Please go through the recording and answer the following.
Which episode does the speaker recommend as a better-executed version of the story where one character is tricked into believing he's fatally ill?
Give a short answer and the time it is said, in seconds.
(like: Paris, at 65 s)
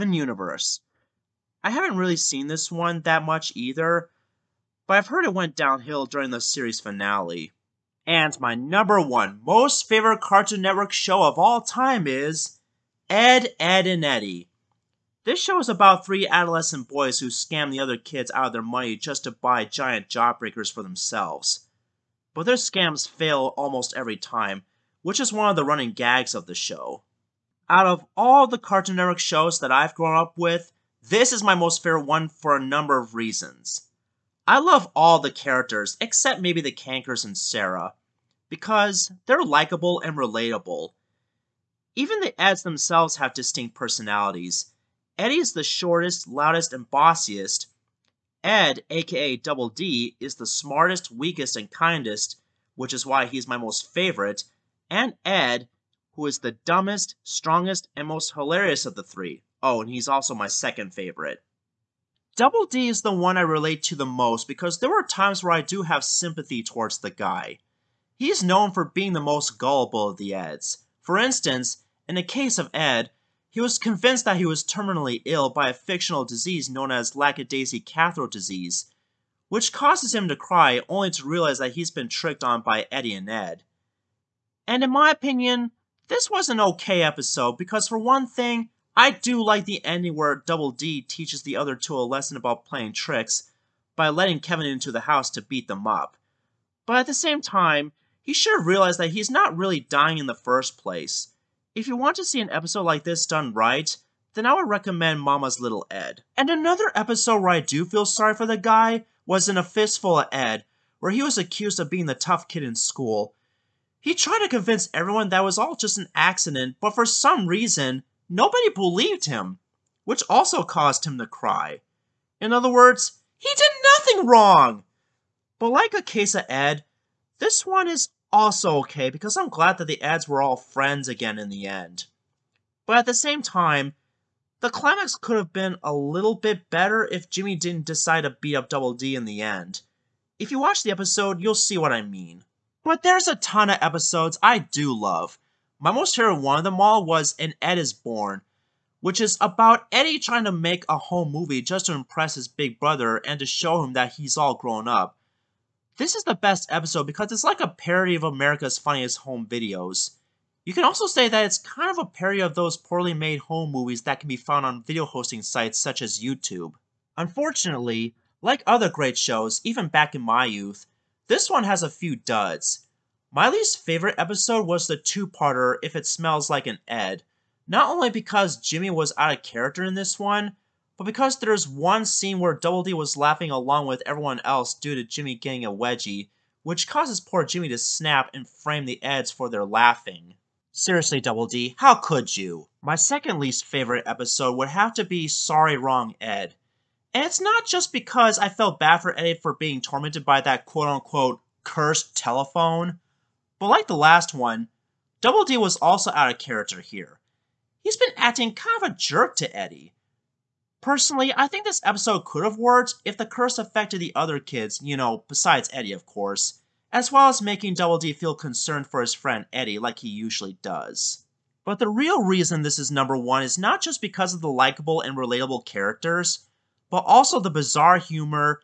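Mama's Little Ed, at 105 s.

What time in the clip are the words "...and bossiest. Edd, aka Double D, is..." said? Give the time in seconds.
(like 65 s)
46 s.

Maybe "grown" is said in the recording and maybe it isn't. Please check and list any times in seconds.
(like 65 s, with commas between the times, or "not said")
29 s, 154 s.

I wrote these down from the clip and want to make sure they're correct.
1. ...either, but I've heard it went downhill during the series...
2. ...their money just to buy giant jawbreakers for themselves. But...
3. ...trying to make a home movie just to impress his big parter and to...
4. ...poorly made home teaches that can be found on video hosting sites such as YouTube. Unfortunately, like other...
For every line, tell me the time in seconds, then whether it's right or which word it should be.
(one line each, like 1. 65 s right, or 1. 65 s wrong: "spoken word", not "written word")
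1. 3 s right
2. 18 s right
3. 150 s wrong: "brother", not "parter"
4. 162 s wrong: "movies", not "teaches".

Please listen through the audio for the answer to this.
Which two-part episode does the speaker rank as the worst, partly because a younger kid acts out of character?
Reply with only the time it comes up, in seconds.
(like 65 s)
175 s.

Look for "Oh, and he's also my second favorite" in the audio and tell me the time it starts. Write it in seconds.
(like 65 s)
59 s.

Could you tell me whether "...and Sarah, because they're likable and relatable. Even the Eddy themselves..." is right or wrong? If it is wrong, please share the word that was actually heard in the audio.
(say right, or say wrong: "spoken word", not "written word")
wrong: "Eds", not "Eddy".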